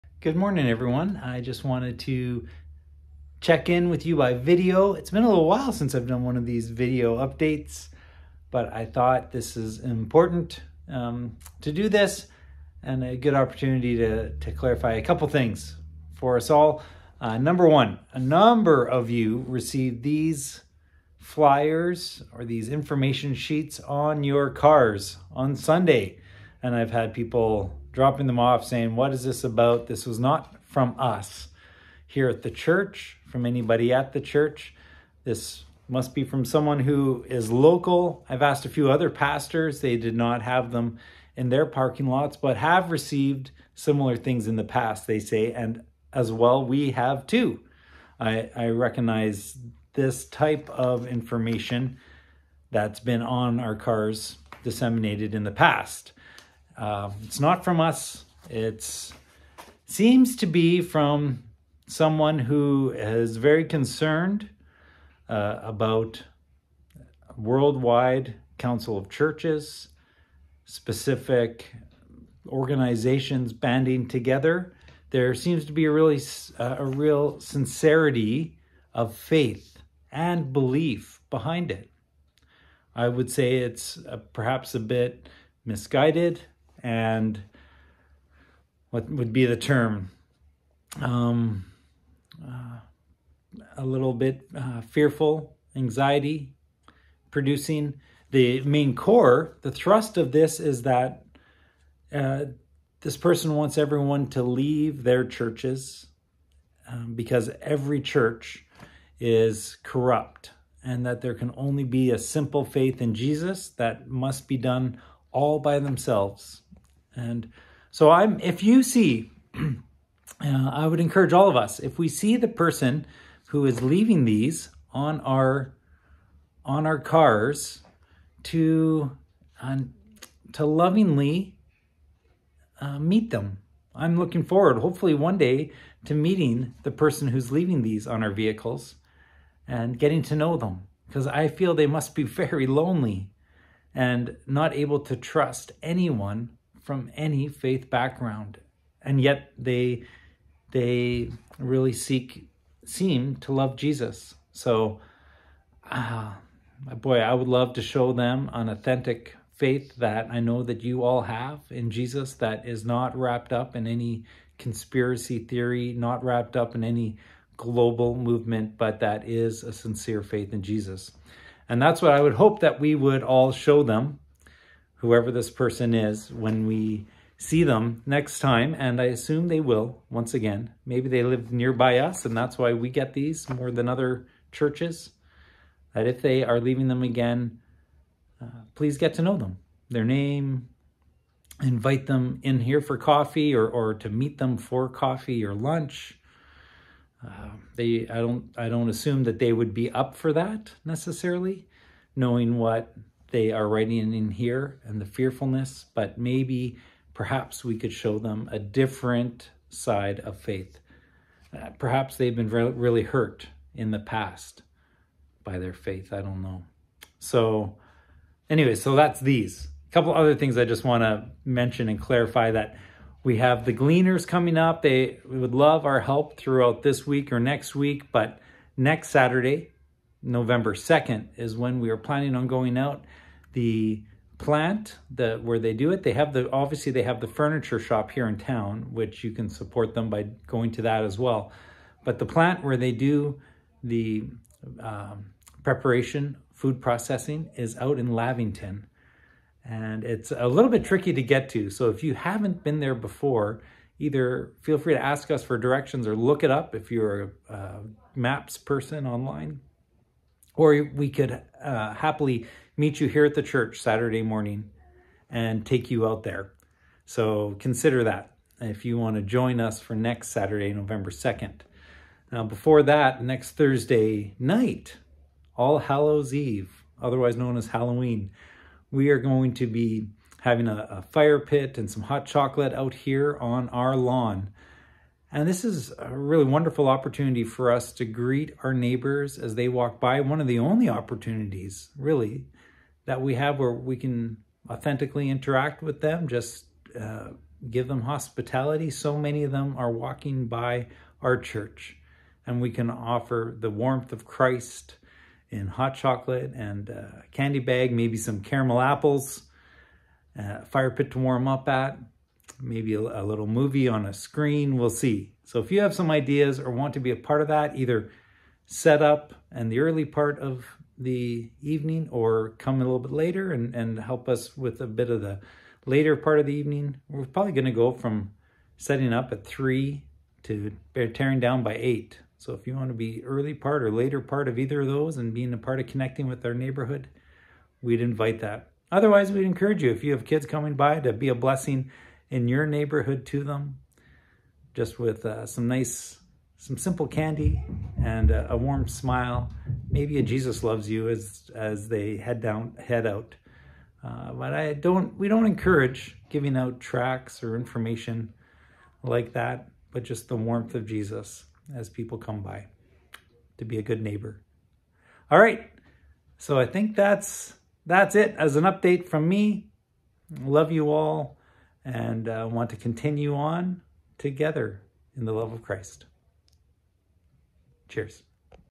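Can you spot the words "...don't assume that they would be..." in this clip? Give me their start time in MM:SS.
03:18.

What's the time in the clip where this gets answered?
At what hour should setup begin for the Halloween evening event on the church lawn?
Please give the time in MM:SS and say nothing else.
05:29.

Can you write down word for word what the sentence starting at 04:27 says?
So consider that if you want to join us for next Saturday, November 2nd.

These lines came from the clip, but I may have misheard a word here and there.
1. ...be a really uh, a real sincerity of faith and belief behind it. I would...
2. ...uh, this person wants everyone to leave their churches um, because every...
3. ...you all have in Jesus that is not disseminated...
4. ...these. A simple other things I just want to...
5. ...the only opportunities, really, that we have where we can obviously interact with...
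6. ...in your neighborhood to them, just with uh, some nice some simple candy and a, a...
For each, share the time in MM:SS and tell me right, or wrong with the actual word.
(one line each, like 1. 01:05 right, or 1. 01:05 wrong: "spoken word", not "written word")
1. 01:15 right
2. 01:42 right
3. 02:40 wrong: "wrapped", not "disseminated"
4. 03:39 wrong: "couple", not "simple"
5. 04:50 wrong: "authentically", not "obviously"
6. 05:42 right.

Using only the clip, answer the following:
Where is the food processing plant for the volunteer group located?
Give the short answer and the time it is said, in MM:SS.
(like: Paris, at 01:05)
Lavington, at 04:08.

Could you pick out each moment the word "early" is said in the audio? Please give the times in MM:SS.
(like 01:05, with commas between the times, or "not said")
05:19, 05:33.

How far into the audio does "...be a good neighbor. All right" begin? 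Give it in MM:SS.
06:03.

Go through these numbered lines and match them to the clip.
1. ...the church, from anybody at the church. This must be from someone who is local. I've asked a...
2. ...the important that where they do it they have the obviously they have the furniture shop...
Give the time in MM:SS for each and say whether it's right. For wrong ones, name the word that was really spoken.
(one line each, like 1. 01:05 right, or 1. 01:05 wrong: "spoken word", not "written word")
1. 00:32 right
2. 03:53 wrong: "plant", not "important".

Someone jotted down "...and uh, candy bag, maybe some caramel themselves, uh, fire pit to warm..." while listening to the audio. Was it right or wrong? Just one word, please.
wrong.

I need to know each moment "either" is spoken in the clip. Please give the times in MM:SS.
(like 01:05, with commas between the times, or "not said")
04:13, 05:17, 05:34.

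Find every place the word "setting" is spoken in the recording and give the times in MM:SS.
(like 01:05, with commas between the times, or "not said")
05:28.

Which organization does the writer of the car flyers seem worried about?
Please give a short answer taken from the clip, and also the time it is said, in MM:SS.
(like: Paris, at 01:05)
Worldwide council of churches, at 01:07.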